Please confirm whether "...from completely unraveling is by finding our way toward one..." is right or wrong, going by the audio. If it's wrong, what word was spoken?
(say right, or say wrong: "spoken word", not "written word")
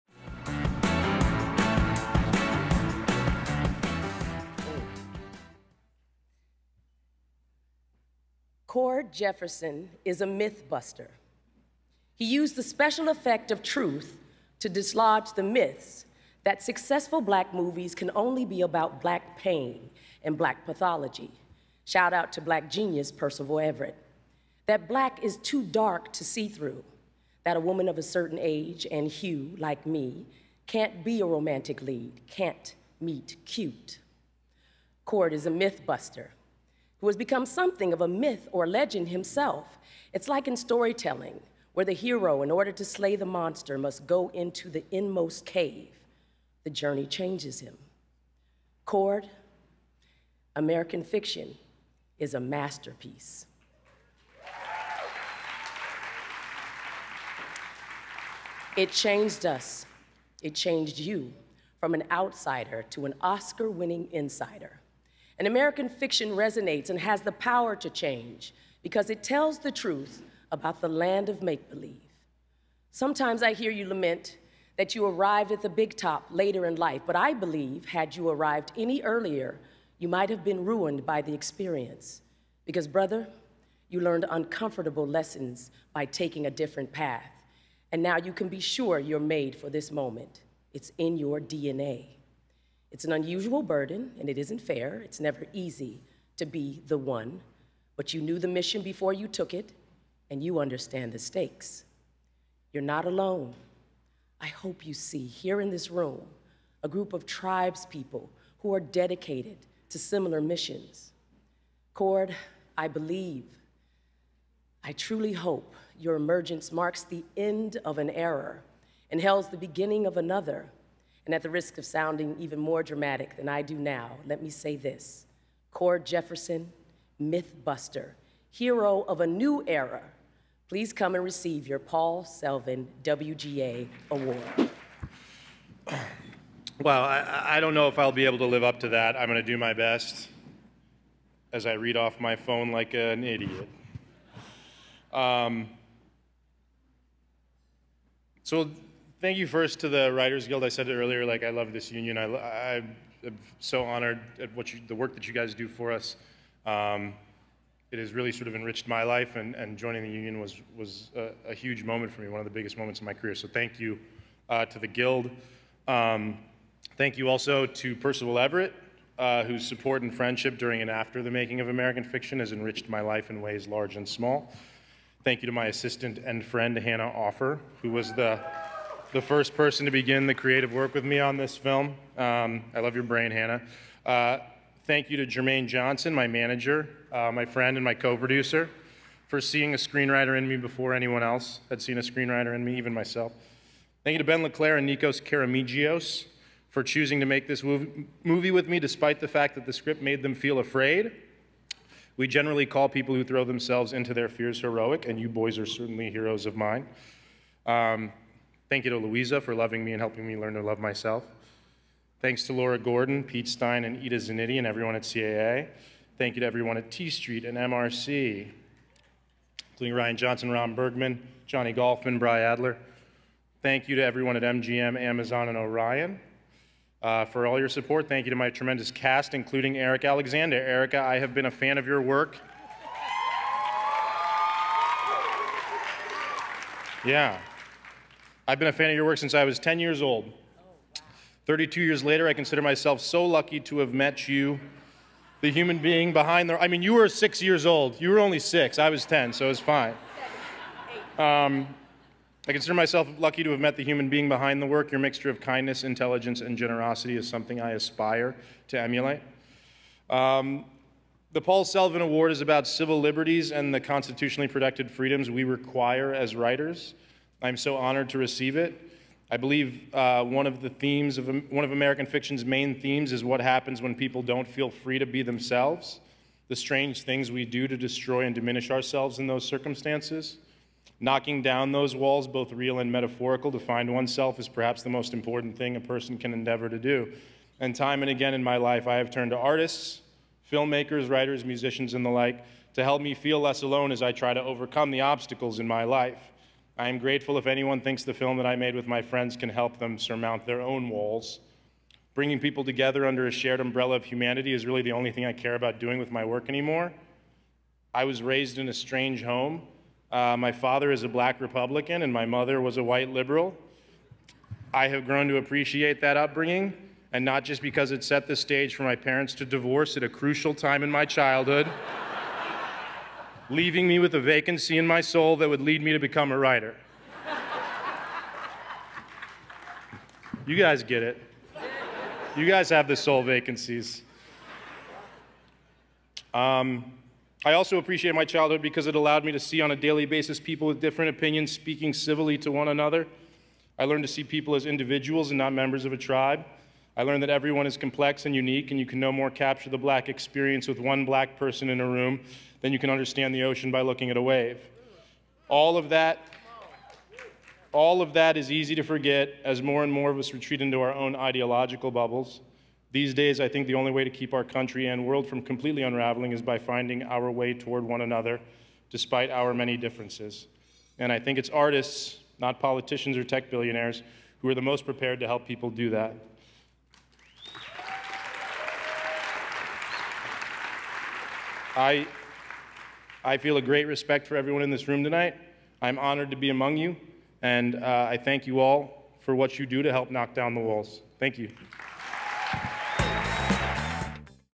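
right.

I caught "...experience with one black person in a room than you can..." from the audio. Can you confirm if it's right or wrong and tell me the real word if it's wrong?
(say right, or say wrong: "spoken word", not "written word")
right.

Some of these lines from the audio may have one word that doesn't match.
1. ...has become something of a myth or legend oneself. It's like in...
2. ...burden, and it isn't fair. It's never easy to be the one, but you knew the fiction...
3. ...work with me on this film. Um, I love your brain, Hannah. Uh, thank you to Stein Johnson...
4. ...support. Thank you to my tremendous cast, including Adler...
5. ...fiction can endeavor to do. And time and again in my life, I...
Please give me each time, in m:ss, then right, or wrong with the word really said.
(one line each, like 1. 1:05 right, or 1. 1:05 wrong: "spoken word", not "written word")
1. 0:37 wrong: "himself", not "oneself"
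2. 1:33 wrong: "mission", not "fiction"
3. 3:00 wrong: "Jermaine", not "Stein"
4. 3:47 wrong: "Erika", not "Adler"
5. 4:45 wrong: "person", not "fiction".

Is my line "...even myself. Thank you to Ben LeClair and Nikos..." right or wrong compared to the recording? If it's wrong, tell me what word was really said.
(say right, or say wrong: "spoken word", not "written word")
right.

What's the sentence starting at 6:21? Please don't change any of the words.
I, I feel a great respect for everyone in this room tonight.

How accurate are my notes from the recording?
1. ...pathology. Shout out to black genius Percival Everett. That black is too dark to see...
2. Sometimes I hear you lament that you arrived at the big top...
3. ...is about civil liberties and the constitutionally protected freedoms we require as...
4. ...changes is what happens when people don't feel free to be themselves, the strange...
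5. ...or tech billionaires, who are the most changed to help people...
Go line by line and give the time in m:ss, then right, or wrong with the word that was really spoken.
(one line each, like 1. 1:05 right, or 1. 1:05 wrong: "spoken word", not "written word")
1. 0:20 right
2. 1:12 right
3. 4:22 right
4. 4:32 wrong: "themes", not "changes"
5. 6:13 wrong: "prepared", not "changed".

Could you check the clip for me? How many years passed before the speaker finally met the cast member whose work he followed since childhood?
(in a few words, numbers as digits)
32.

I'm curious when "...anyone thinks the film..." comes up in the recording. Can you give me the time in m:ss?
4:57.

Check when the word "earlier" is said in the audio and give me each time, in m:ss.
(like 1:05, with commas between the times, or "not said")
1:19, 2:30.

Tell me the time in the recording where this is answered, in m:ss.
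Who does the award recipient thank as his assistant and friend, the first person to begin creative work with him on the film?
2:56.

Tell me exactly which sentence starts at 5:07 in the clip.
I was raised in a strange home.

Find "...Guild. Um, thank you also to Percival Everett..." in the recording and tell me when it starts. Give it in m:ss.
2:44.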